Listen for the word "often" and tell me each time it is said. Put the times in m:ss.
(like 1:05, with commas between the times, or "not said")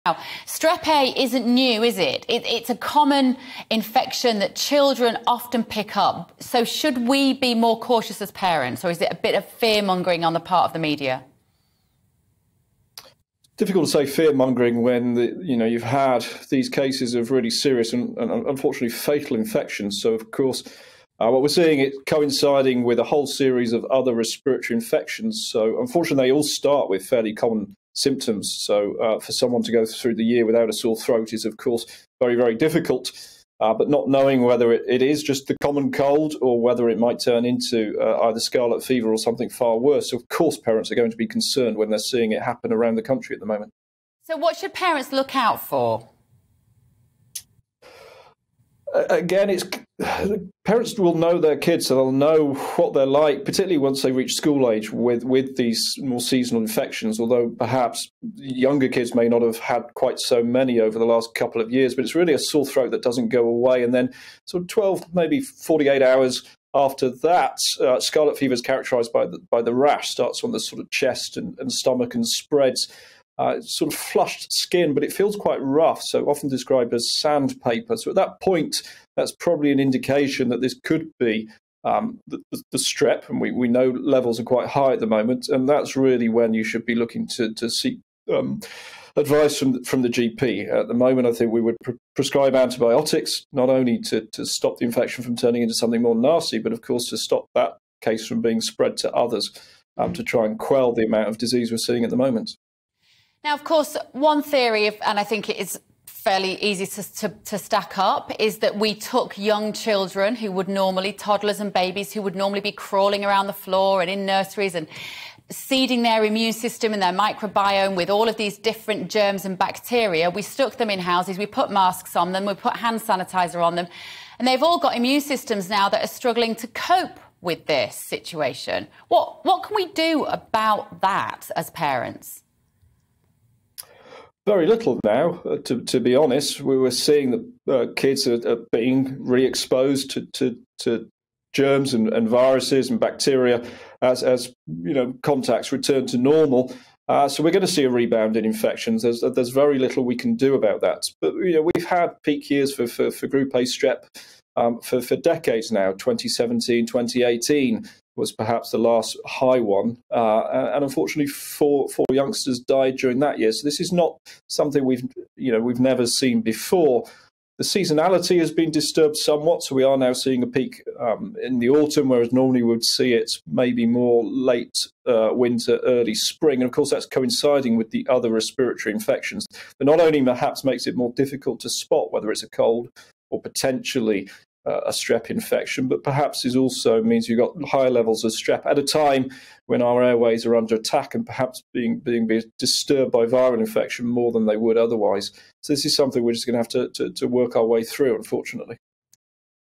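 0:05, 1:16.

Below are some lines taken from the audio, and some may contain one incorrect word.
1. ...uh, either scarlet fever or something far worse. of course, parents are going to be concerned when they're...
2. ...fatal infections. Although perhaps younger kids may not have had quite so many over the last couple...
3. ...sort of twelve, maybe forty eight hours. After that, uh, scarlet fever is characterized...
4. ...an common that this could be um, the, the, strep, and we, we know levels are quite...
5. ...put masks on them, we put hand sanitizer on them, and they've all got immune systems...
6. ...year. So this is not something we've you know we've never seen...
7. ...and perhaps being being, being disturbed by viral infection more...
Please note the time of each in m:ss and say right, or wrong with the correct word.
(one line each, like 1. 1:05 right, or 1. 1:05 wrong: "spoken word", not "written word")
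1. 0:38 right
2. 0:56 wrong: "seasonal", not "fatal"
3. 1:04 right
4. 1:19 wrong: "indication", not "common"
5. 2:01 right
6. 2:43 right
7. 3:11 right.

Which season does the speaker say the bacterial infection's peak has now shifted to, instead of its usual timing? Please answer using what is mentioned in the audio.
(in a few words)
autumn.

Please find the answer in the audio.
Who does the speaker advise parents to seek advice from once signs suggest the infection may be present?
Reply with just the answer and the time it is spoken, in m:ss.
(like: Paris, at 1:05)
the GP, at 1:30.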